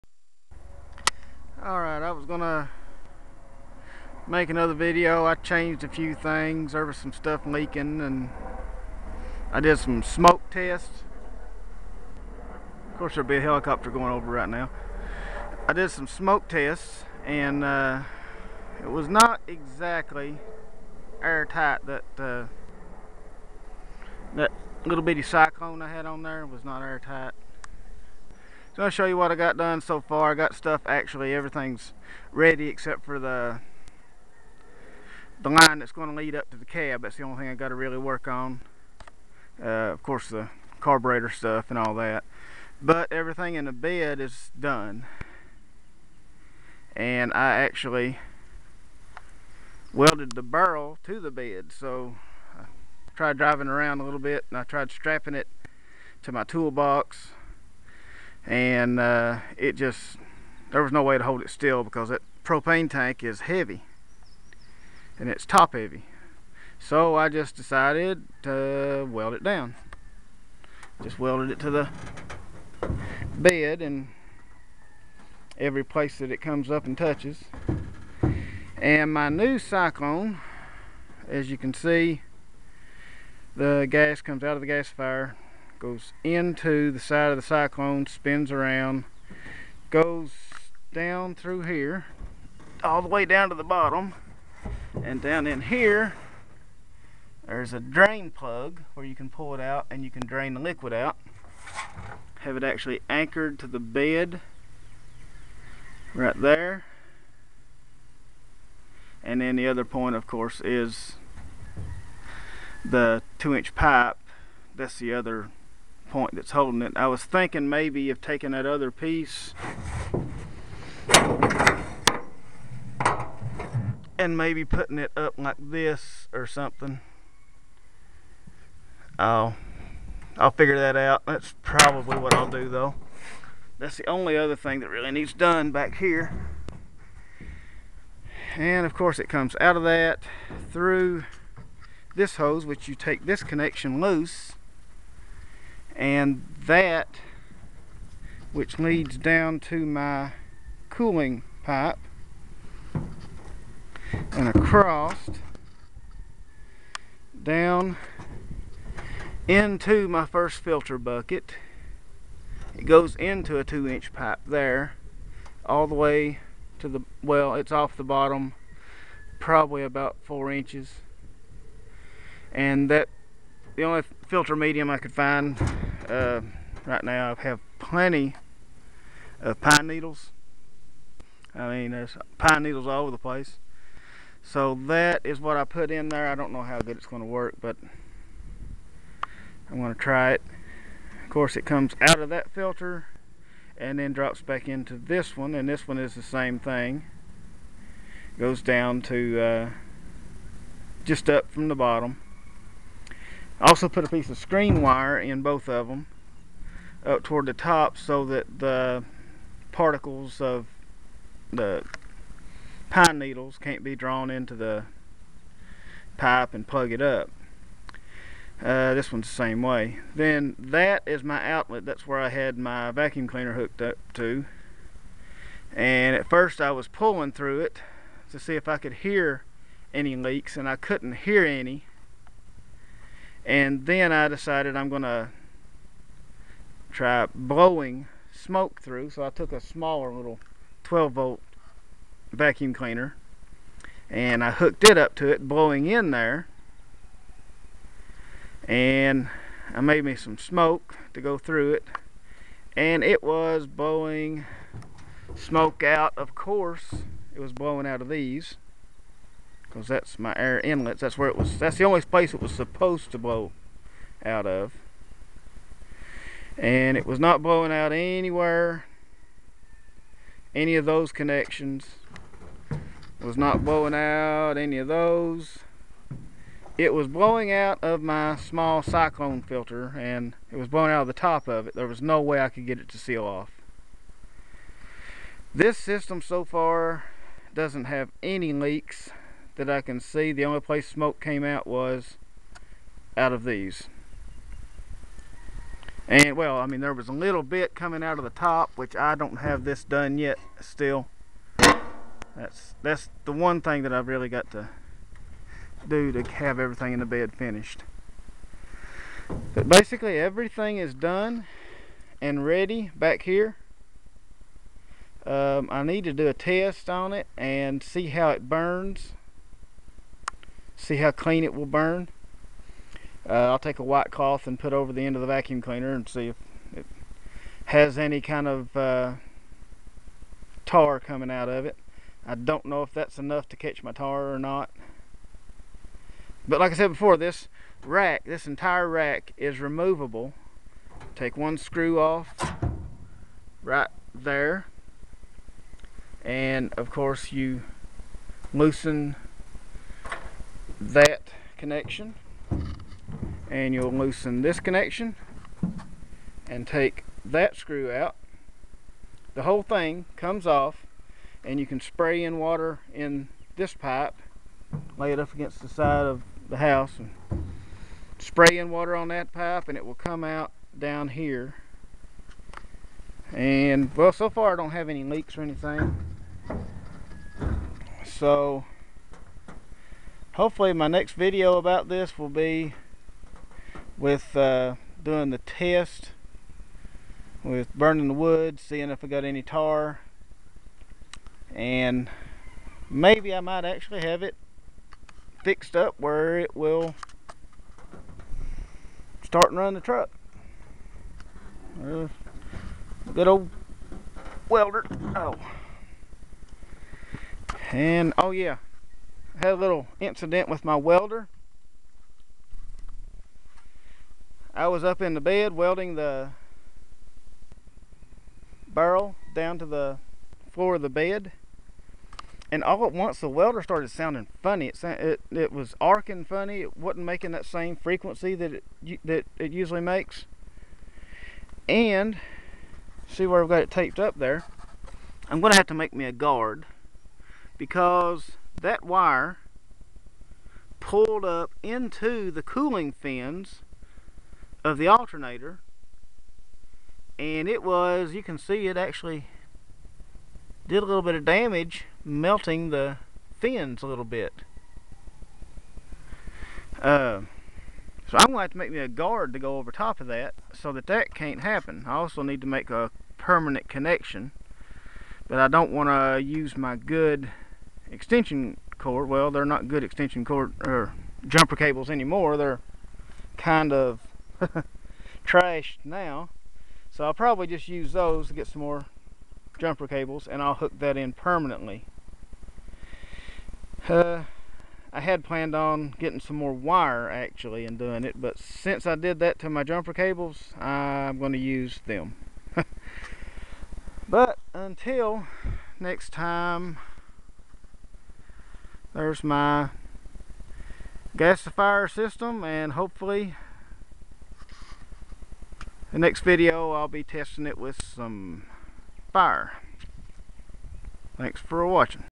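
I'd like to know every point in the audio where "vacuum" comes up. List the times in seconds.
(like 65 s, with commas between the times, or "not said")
222 s, 242 s, 325 s.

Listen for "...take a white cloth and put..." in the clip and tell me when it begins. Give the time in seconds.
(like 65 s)
323 s.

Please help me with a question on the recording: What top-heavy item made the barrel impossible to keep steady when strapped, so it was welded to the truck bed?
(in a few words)
propane tank.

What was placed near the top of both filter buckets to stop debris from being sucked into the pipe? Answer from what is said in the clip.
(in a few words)
screen wire.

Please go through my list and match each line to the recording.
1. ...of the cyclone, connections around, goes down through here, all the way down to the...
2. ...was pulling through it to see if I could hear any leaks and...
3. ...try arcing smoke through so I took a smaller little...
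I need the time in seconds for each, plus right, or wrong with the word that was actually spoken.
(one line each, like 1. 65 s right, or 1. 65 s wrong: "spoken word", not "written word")
1. 87 s wrong: "spins", not "connections"
2. 226 s right
3. 236 s wrong: "blowing", not "arcing".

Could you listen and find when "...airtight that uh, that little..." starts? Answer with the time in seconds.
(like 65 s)
21 s.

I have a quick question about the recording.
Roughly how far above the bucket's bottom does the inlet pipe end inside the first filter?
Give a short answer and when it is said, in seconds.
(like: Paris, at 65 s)
4 inches, at 169 s.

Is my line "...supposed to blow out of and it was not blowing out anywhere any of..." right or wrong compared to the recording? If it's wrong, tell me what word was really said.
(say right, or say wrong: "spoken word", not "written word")
right.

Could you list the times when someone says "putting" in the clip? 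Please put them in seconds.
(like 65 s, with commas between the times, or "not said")
124 s.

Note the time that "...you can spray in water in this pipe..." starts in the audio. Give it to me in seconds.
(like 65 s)
361 s.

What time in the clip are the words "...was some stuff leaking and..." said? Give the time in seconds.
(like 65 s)
6 s.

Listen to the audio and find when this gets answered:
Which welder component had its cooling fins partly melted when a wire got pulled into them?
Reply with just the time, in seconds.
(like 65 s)
444 s.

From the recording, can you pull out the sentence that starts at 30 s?
I got stuff actually everything's ready except for the the line that's going to lead up to the cab.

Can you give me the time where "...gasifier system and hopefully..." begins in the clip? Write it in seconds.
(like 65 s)
501 s.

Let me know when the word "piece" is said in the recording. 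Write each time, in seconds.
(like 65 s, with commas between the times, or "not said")
118 s, 204 s.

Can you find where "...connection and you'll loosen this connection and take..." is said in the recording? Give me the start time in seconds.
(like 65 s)
351 s.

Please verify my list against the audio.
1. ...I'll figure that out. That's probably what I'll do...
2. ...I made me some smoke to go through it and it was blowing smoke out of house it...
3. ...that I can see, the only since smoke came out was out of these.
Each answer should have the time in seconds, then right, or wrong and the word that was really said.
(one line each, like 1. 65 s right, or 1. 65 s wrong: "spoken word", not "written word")
1. 130 s right
2. 249 s wrong: "course", not "house"
3. 289 s wrong: "place", not "since".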